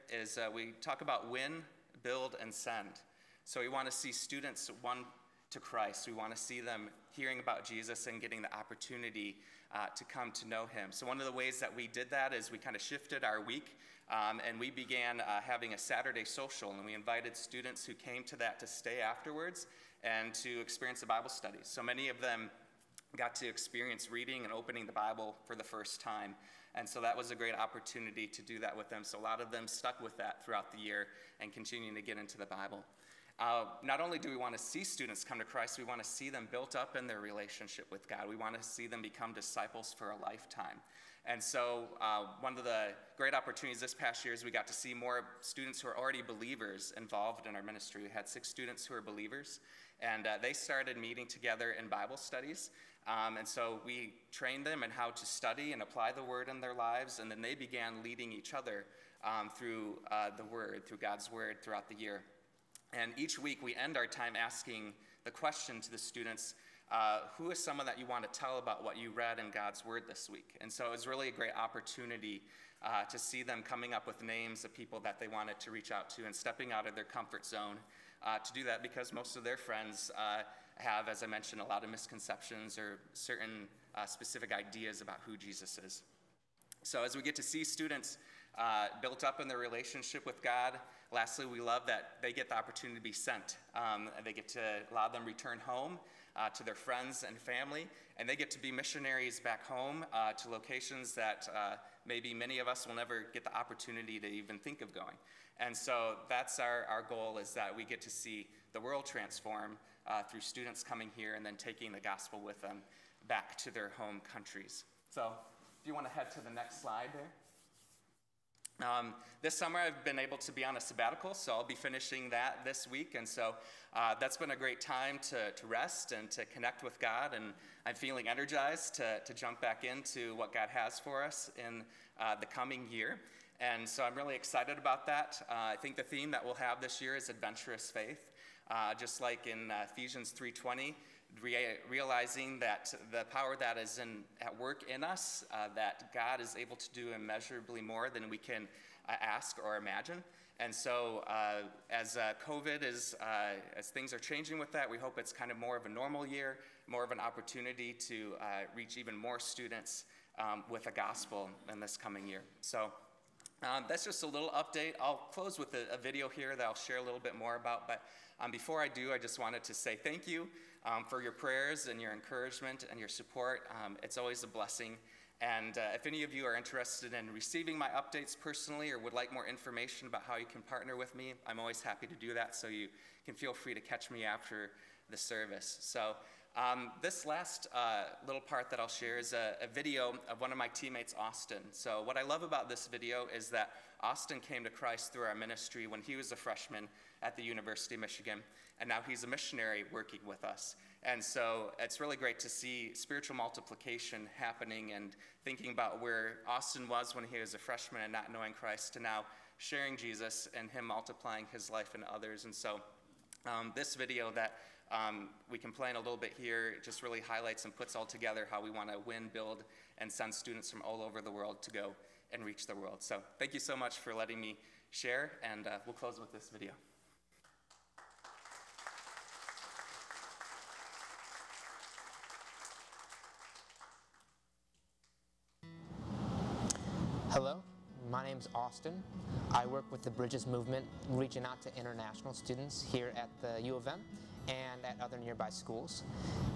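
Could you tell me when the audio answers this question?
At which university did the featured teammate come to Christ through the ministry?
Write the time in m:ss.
3:17.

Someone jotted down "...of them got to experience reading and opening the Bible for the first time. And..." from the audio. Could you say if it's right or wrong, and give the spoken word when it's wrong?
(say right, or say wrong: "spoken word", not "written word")
right.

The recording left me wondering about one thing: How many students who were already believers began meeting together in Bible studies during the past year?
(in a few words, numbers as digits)
6.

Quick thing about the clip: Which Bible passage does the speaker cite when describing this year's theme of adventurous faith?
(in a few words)
Ephesians 3:20.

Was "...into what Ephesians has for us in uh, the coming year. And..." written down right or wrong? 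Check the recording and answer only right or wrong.
wrong.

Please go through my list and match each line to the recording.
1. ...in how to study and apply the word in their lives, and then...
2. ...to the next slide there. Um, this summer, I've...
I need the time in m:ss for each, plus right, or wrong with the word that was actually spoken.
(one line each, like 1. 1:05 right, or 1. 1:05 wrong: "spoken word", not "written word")
1. 0:54 right
2. 1:56 right.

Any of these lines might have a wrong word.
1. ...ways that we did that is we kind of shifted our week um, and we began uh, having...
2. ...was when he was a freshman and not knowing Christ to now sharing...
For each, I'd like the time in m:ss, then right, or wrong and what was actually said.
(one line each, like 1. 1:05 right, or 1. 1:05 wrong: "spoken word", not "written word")
1. 0:11 right
2. 3:26 right.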